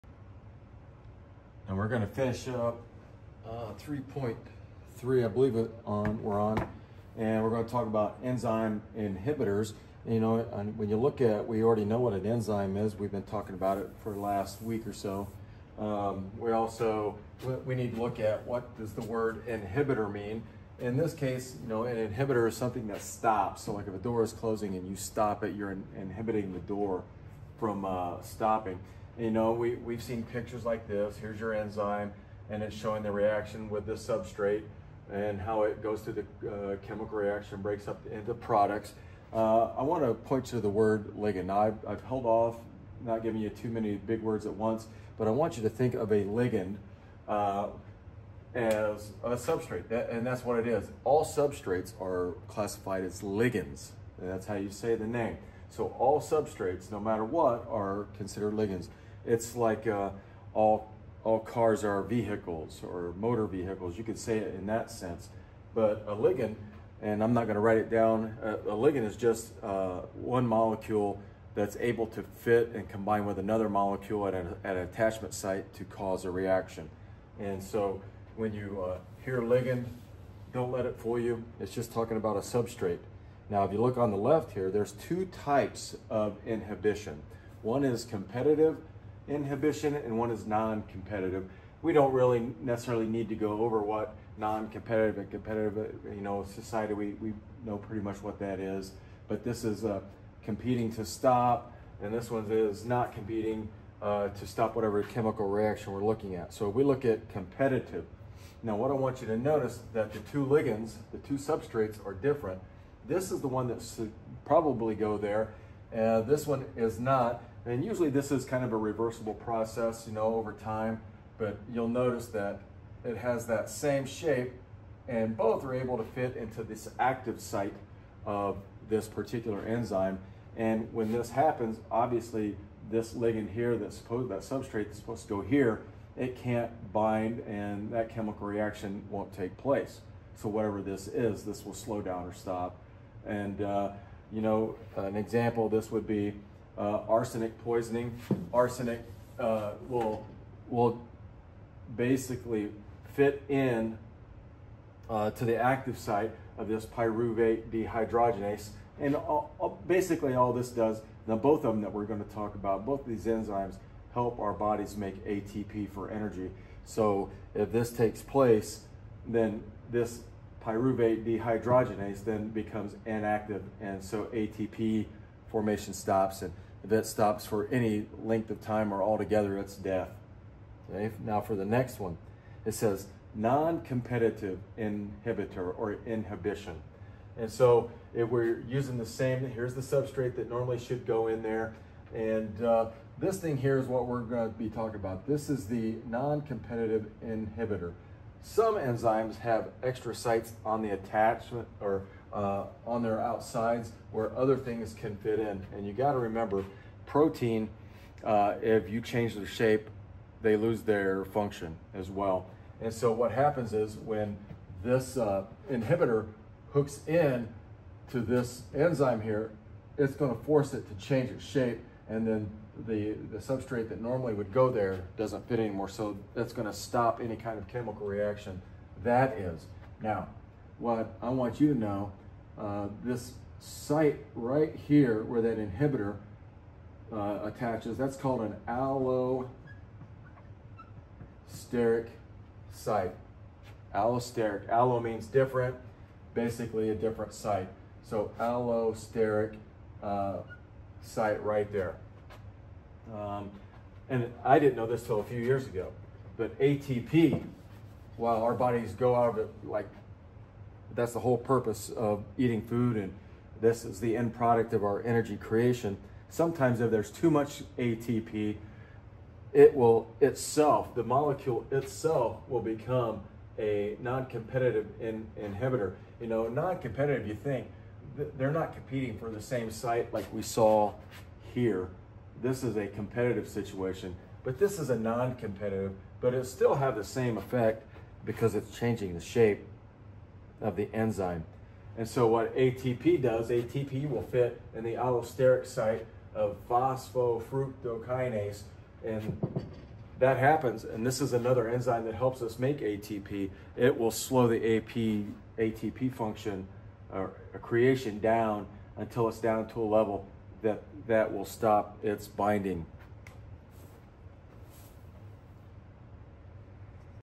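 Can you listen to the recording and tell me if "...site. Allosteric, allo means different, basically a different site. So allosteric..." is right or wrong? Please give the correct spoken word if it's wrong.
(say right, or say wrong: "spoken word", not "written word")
right.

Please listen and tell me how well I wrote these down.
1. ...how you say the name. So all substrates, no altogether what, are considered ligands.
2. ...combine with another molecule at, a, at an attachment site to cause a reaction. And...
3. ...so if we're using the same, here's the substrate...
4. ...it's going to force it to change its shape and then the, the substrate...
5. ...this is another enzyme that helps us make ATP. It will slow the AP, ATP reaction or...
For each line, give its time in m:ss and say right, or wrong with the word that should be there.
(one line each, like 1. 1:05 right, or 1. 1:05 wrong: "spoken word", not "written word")
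1. 0:54 wrong: "matter", not "altogether"
2. 1:12 right
3. 3:07 right
4. 3:39 right
5. 5:01 wrong: "function", not "reaction".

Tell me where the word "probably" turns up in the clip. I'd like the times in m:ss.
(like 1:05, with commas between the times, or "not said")
1:54.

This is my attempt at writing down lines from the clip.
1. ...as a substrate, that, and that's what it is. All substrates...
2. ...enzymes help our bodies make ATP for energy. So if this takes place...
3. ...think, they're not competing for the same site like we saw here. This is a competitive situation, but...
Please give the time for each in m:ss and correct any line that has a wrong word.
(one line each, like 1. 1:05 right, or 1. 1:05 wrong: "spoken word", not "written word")
1. 0:48 right
2. 2:43 right
3. 4:37 right.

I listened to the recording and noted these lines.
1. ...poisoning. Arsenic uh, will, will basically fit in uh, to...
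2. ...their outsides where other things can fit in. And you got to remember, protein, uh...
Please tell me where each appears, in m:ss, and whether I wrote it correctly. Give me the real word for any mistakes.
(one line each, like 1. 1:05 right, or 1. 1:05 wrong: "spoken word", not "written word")
1. 2:27 right
2. 3:23 right.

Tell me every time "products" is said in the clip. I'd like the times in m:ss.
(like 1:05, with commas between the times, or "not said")
0:38, 4:24.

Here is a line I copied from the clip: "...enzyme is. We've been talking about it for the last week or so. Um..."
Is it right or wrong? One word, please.
right.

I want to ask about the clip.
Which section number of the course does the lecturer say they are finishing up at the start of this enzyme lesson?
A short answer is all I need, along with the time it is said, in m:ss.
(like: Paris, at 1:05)
3.3, at 0:03.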